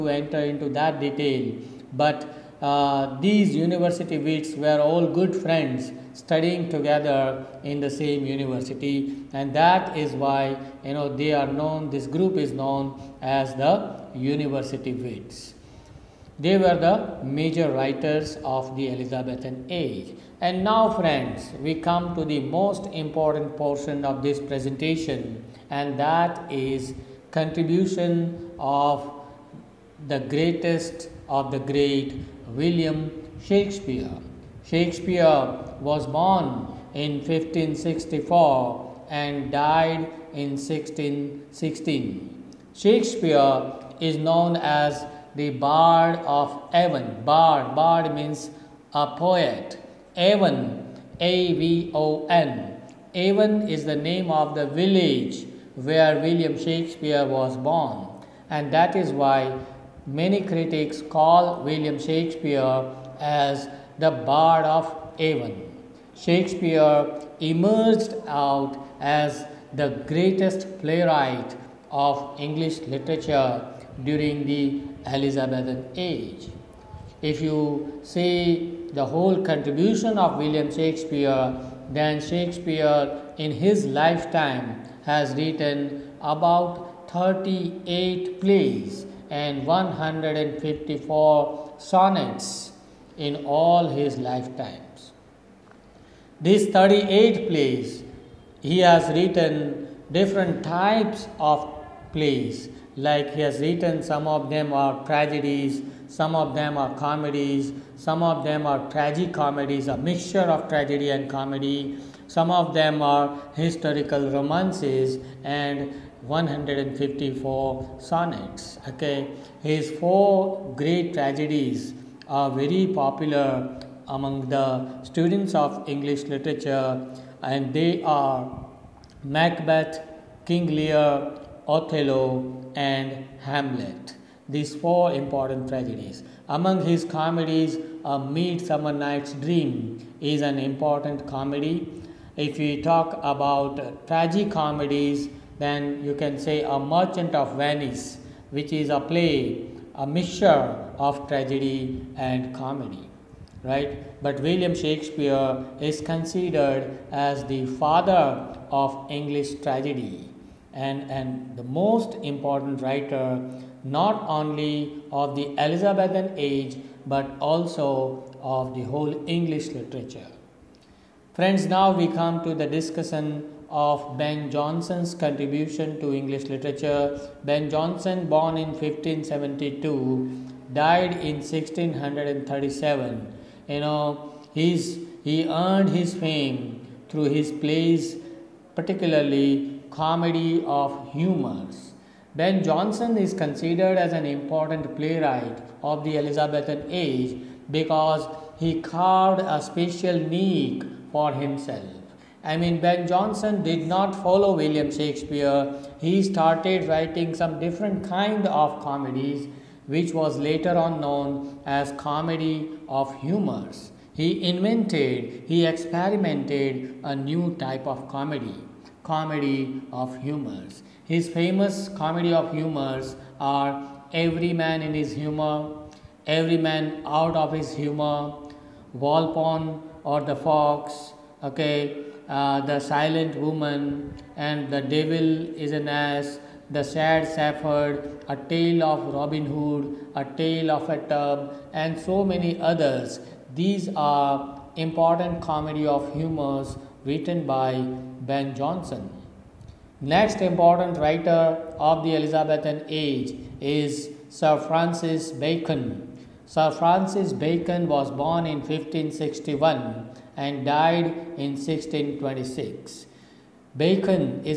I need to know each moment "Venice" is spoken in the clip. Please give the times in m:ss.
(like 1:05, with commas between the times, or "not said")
2:27.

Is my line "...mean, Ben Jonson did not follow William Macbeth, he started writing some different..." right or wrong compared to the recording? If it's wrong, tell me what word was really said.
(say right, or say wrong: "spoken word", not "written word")
wrong: "Shakespeare", not "Macbeth".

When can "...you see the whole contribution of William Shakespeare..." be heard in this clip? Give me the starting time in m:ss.
1:17.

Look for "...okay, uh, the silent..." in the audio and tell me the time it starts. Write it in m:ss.
3:51.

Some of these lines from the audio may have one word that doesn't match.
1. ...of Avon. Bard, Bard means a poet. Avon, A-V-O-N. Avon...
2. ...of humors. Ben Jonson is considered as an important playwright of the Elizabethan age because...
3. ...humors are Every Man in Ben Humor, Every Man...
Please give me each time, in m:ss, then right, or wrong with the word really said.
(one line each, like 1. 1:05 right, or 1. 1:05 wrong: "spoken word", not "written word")
1. 0:46 right
2. 3:10 right
3. 3:42 wrong: "His", not "Ben".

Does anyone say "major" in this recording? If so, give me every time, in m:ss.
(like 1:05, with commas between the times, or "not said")
0:17.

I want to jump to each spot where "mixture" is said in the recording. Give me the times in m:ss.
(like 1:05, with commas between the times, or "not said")
1:49, 2:30.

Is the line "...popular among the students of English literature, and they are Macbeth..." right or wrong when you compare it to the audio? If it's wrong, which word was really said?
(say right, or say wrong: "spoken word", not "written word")
right.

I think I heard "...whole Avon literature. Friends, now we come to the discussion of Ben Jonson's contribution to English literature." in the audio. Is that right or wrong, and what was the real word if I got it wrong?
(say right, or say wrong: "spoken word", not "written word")
wrong: "English", not "Avon".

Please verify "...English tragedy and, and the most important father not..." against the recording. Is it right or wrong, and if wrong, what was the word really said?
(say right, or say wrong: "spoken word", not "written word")
wrong: "writer", not "father".